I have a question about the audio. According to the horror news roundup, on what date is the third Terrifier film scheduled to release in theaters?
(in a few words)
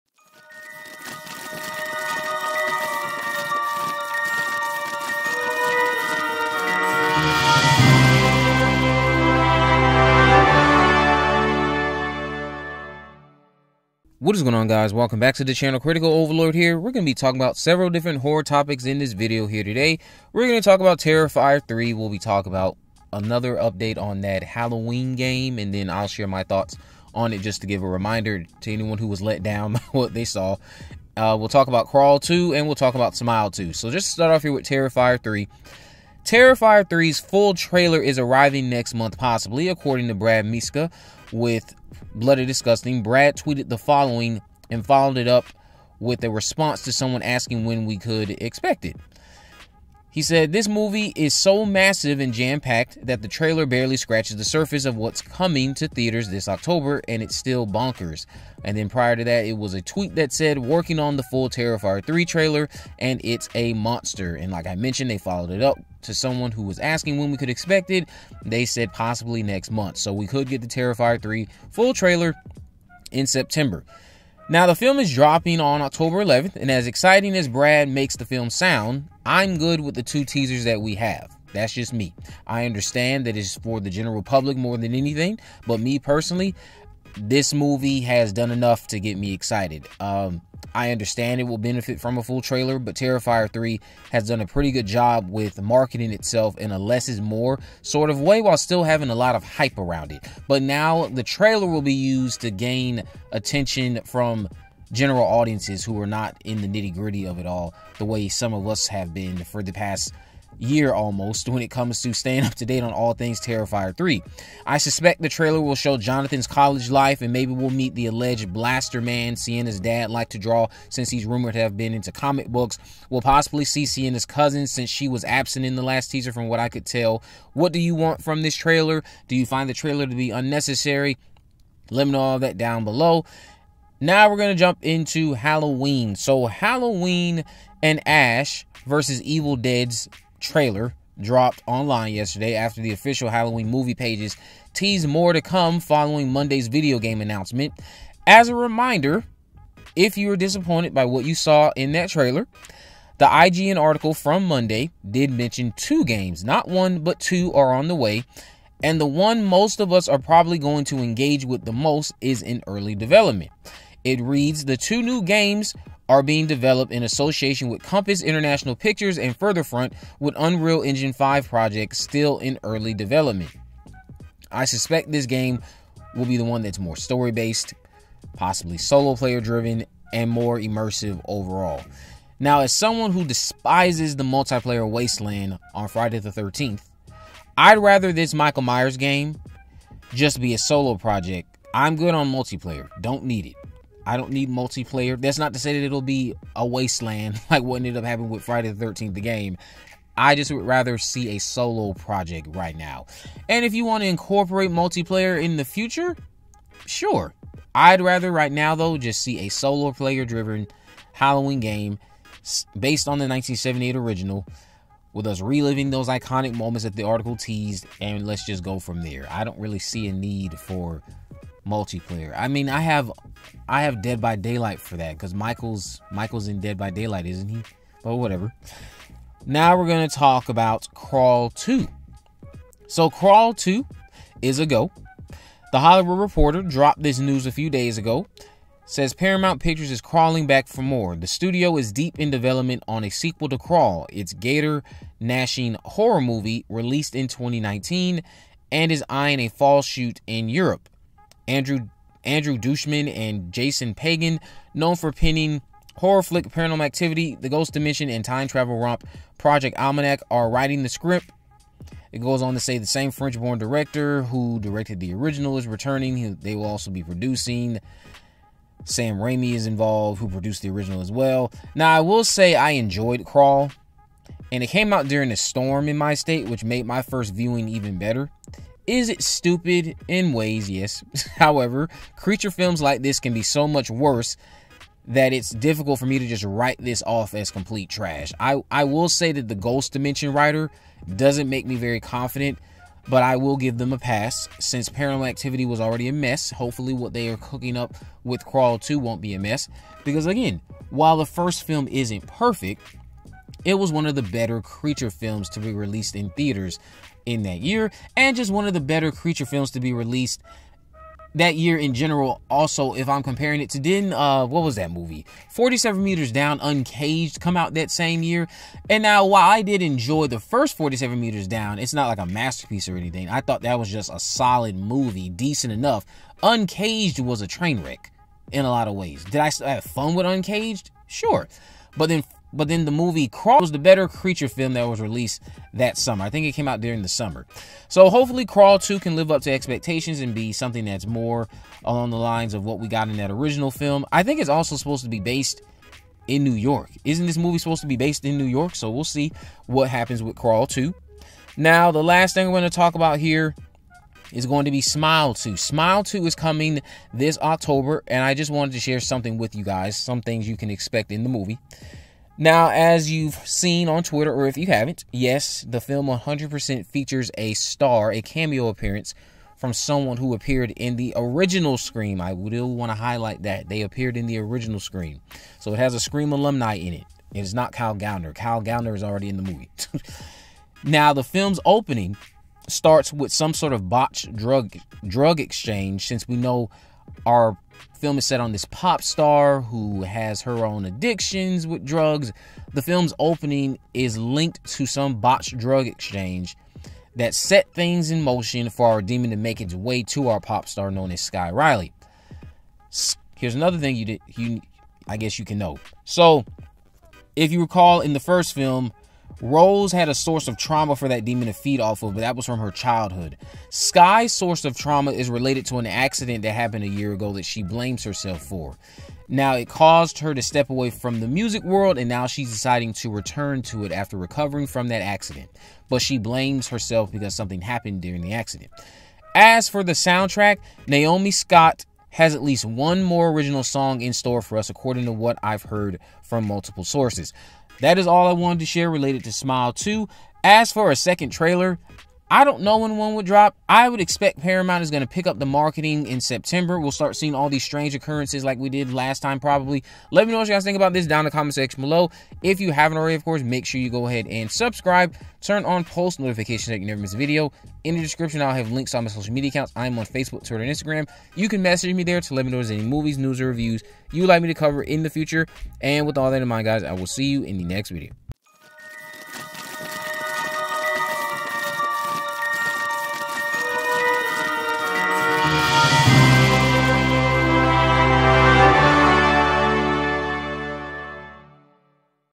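October 11th.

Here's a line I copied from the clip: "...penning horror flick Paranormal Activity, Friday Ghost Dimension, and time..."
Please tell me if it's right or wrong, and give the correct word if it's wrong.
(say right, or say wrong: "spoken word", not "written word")
wrong: "The", not "Friday".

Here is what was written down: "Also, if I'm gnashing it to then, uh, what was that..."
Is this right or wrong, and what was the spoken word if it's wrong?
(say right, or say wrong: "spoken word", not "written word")
wrong: "comparing", not "gnashing".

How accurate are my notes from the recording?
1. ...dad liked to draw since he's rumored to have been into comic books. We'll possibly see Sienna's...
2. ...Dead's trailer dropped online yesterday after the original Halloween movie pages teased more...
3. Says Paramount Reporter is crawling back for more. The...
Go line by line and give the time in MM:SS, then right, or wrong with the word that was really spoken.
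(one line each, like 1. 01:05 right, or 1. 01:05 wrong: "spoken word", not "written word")
1. 01:59 right
2. 02:19 wrong: "official", not "original"
3. 03:58 wrong: "Pictures", not "Reporter".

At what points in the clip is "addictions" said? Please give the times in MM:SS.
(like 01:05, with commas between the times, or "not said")
06:30.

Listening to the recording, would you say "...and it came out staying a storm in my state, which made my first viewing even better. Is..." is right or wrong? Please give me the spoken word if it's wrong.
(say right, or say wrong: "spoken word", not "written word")
wrong: "during", not "staying".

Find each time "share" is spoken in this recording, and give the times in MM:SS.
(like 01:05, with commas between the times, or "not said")
00:26, 05:58, 07:18.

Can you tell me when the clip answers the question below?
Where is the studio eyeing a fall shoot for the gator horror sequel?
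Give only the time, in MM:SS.
04:10.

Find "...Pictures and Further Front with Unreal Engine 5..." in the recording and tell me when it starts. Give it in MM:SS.
02:48.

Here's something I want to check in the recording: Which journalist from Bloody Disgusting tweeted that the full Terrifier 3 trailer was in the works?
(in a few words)
Brad Miska.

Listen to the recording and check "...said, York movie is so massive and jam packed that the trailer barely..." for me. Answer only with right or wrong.
wrong.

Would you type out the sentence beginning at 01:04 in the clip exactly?
And like I mentioned, they followed it up to someone who was asking when we could expect it.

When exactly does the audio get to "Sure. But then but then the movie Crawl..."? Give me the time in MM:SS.
05:31.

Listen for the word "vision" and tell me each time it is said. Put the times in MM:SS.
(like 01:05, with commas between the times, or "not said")
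not said.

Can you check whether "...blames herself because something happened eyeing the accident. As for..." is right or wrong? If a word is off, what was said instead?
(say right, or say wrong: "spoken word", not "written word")
wrong: "during", not "eyeing".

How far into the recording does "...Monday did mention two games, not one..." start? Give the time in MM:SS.
02:34.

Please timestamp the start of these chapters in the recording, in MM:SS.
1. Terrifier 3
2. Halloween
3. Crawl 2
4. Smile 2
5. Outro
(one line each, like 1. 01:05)
1. 00:14
2. 02:14
3. 03:50
4. 05:53
5. 07:47.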